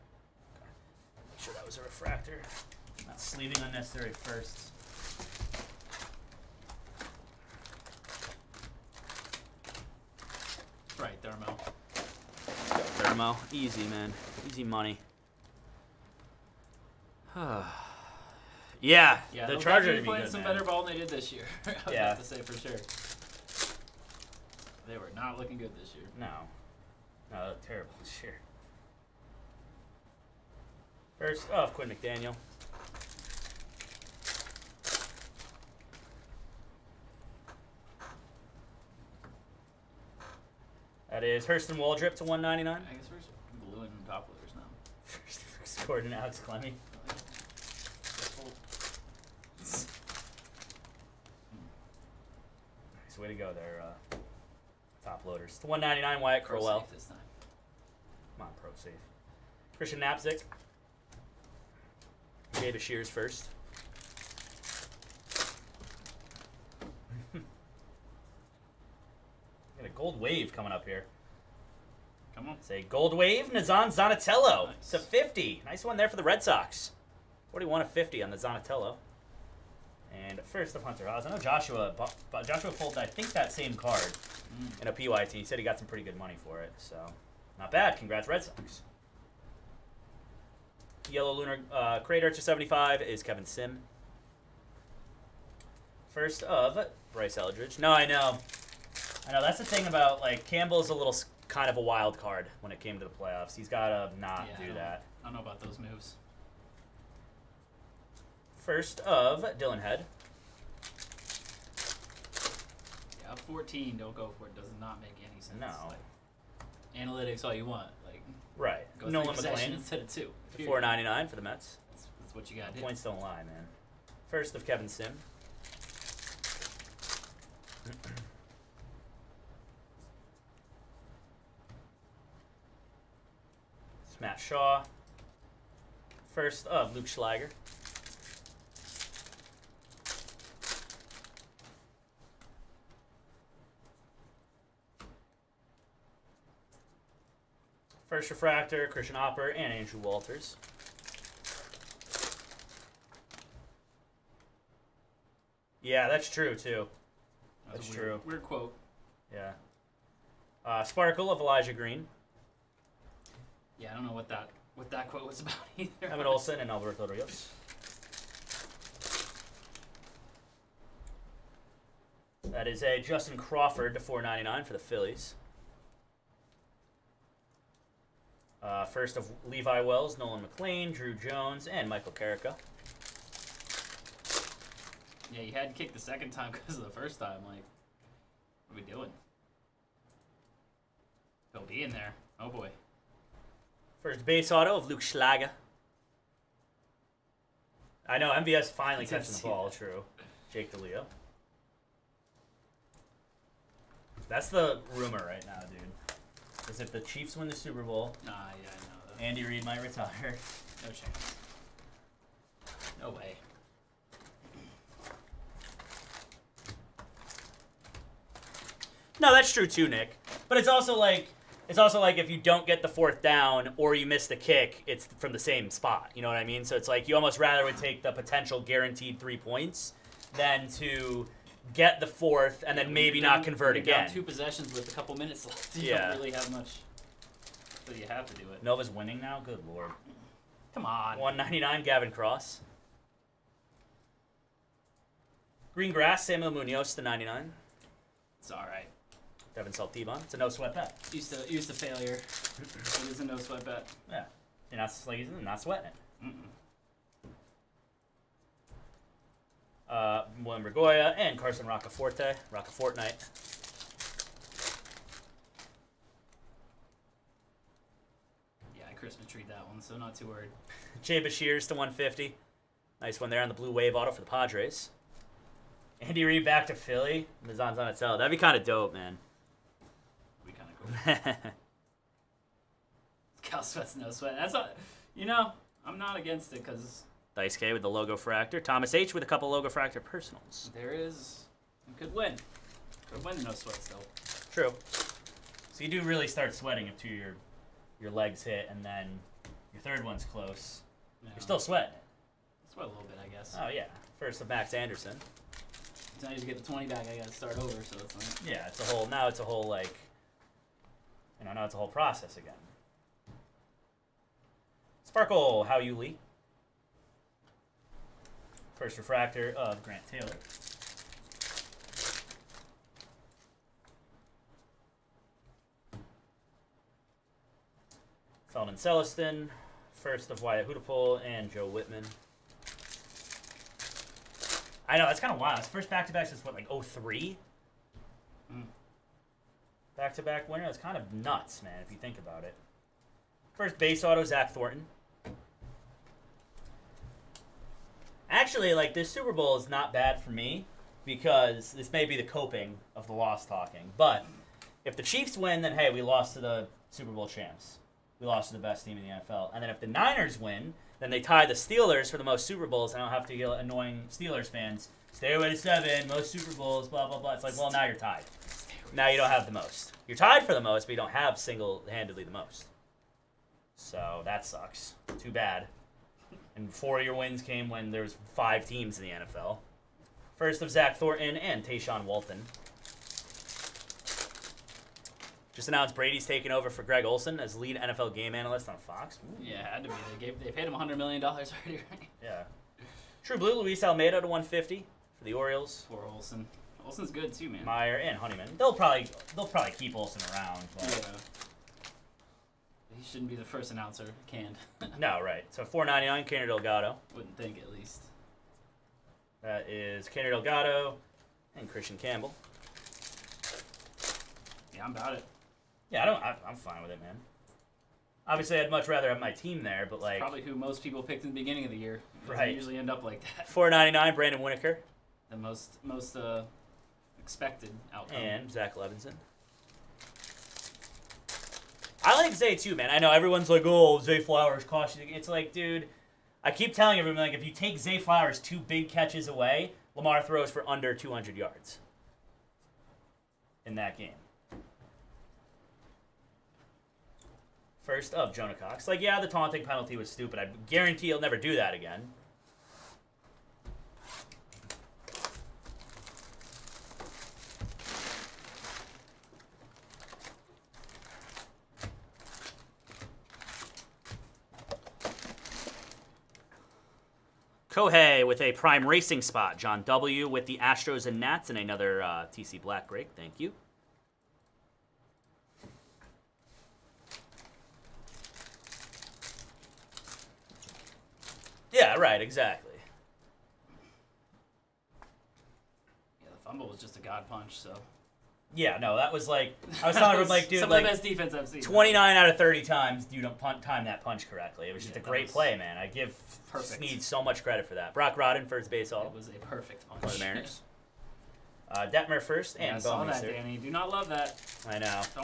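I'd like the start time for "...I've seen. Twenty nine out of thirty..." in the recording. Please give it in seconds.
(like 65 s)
491 s.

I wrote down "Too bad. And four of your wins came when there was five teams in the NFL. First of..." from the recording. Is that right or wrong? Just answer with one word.
right.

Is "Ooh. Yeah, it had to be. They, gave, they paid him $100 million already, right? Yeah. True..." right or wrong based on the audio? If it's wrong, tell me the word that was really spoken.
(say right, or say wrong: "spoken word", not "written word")
right.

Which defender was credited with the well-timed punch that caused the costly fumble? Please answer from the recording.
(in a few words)
Sneed.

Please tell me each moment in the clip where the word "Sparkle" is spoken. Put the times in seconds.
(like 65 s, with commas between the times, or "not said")
160 s, 315 s.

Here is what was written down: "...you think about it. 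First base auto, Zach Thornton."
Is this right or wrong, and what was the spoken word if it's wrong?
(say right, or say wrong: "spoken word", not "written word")
right.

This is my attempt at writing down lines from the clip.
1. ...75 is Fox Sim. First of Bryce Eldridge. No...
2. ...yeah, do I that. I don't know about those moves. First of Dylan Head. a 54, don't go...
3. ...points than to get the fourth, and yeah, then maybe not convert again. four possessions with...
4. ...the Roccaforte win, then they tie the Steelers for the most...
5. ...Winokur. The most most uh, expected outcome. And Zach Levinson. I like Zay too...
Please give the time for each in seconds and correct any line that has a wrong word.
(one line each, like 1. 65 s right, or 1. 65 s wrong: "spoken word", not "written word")
1. 92 s wrong: "Kevin", not "Fox"
2. 104 s wrong: "14", not "54"
3. 229 s wrong: "two", not "four"
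4. 359 s wrong: "Niners", not "Roccaforte"
5. 424 s right.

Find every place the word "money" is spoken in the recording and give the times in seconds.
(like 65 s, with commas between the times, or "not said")
14 s, 86 s.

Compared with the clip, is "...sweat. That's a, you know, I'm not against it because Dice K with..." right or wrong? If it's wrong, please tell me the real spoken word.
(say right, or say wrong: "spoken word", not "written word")
right.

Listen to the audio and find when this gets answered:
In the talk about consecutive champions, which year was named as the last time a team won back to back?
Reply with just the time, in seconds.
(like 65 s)
336 s.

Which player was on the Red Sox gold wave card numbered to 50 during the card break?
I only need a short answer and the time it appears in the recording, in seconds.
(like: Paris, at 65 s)
Nazzan Zanetello, at 73 s.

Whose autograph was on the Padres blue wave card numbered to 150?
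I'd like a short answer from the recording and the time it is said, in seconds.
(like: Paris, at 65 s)
Jay Bashirs, at 271 s.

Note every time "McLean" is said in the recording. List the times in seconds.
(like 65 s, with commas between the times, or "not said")
119 s, 180 s.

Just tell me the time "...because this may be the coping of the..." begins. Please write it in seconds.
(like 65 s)
351 s.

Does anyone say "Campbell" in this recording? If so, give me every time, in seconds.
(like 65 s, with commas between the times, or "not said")
100 s, 411 s.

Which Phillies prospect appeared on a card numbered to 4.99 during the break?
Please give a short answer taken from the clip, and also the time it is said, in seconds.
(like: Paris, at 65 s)
Justin Crawford, at 173 s.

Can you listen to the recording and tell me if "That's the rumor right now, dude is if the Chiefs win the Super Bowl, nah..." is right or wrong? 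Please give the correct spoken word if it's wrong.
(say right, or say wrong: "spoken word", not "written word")
right.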